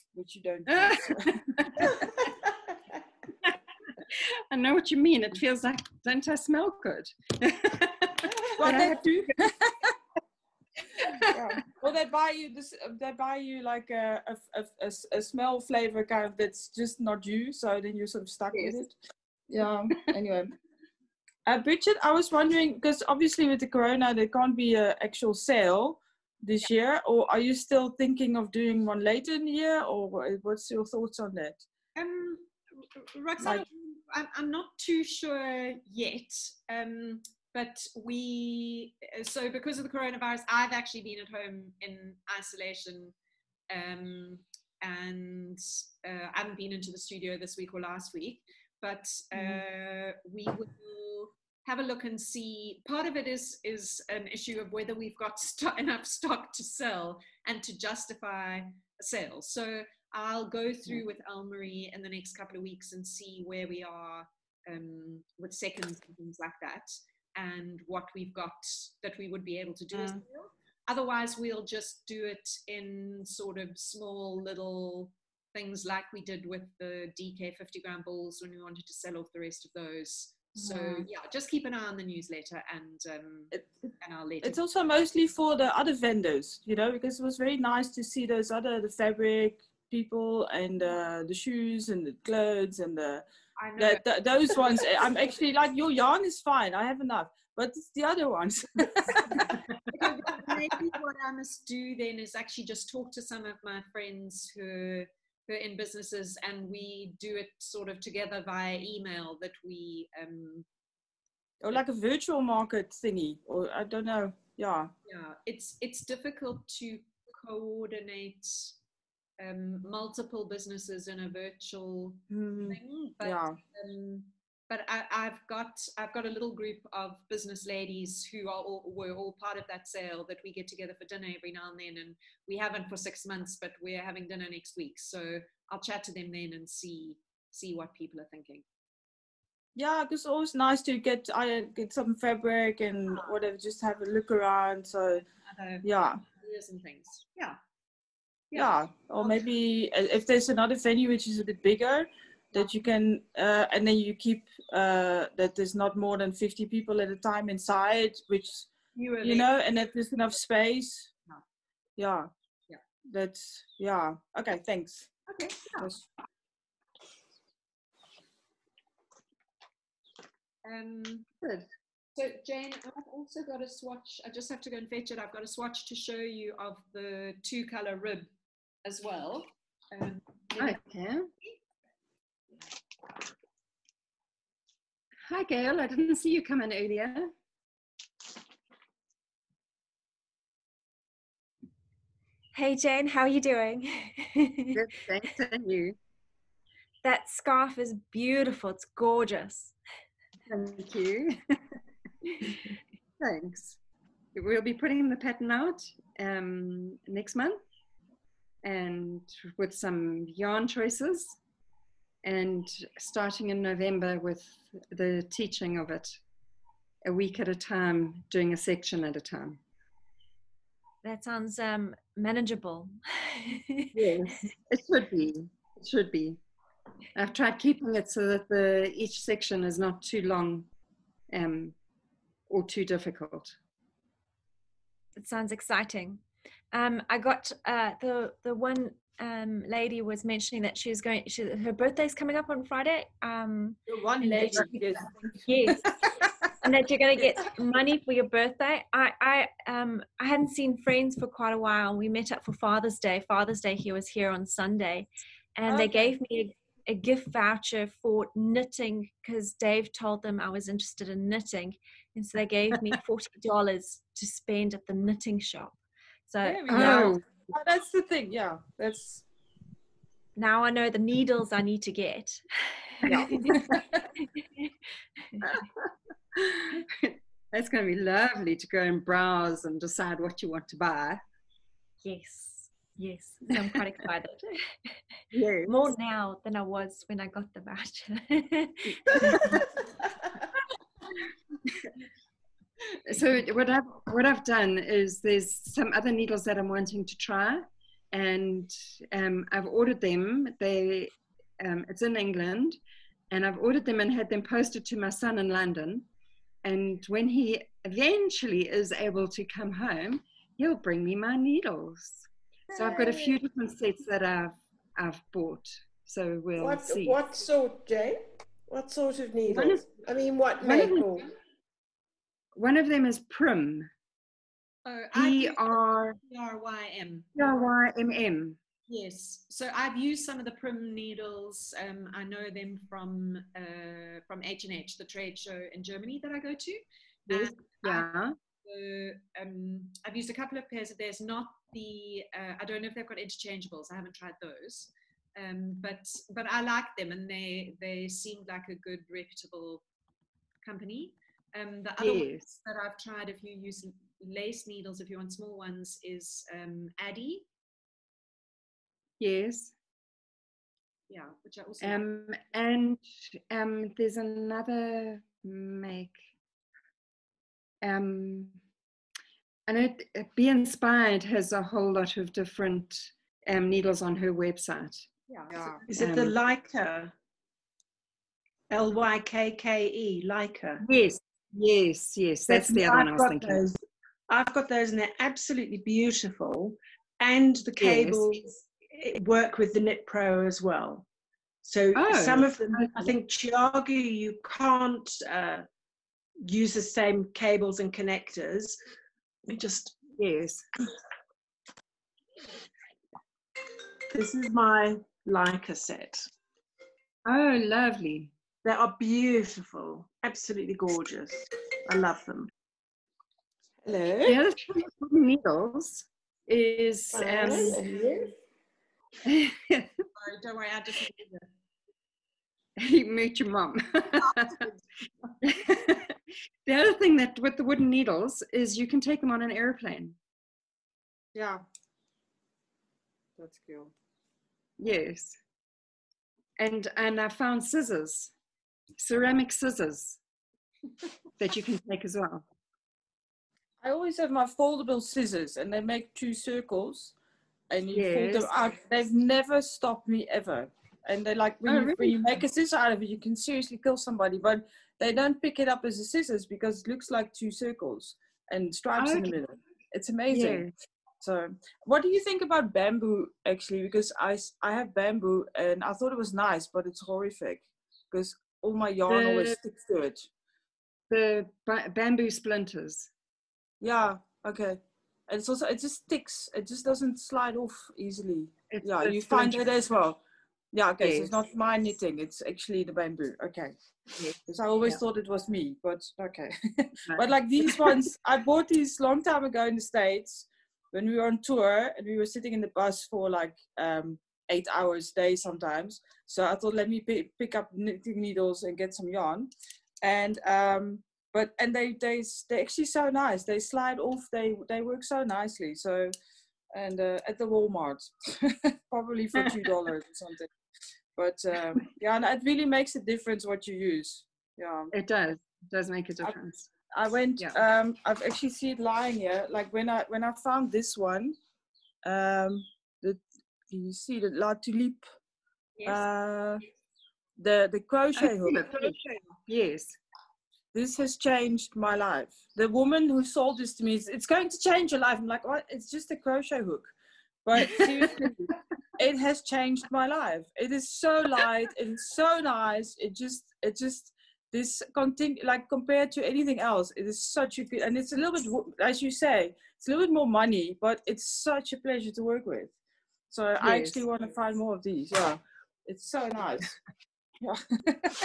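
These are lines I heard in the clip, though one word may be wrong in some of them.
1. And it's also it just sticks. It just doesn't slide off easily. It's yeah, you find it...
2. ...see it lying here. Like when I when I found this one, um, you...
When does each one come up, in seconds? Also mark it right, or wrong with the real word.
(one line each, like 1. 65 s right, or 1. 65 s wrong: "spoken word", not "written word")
1. 475 s right
2. 518 s right.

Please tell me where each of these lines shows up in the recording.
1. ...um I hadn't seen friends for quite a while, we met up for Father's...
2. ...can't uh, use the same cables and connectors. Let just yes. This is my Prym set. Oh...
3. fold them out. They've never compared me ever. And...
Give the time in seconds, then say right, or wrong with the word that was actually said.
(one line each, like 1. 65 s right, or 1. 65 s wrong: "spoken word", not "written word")
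1. 249 s right
2. 394 s wrong: "Lykke", not "Prym"
3. 448 s wrong: "stopped", not "compared".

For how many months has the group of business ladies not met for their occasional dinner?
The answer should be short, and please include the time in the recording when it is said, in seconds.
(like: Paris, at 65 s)
6, at 132 s.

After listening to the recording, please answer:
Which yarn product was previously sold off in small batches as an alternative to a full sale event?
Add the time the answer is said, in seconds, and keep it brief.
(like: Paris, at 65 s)
DK 50 gram balls, at 77 s.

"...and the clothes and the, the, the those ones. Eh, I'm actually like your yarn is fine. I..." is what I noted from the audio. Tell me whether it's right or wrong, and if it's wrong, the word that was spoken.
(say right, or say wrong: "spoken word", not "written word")
right.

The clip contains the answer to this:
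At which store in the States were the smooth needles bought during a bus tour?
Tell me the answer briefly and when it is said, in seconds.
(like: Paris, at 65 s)
Walmart, at 507 s.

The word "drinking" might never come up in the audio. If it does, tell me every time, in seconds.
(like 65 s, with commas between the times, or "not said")
not said.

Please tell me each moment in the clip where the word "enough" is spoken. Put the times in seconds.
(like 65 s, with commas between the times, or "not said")
55 s, 97 s, 160 s.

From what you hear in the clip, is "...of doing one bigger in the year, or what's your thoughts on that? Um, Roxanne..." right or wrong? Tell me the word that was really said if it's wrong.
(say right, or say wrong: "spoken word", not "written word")
wrong: "later", not "bigger".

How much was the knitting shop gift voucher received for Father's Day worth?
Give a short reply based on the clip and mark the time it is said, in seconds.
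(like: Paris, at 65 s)
$40, at 263 s.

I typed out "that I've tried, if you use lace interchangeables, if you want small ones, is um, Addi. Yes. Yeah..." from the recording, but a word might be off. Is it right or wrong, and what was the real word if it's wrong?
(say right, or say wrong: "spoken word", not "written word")
wrong: "needles", not "interchangeables".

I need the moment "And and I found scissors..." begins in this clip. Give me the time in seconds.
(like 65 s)
436 s.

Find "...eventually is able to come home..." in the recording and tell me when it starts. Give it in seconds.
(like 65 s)
307 s.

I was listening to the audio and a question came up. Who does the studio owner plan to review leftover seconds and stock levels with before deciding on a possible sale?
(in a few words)
Elmarie.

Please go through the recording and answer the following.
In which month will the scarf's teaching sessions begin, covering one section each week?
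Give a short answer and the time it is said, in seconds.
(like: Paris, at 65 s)
November, at 213 s.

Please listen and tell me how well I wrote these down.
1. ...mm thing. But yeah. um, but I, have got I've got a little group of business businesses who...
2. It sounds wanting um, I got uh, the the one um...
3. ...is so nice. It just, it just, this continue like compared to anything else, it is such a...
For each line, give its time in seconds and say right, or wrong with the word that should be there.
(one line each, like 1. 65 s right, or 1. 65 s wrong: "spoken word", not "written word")
1. 122 s wrong: "ladies", not "businesses"
2. 235 s wrong: "exciting", not "wanting"
3. 541 s right.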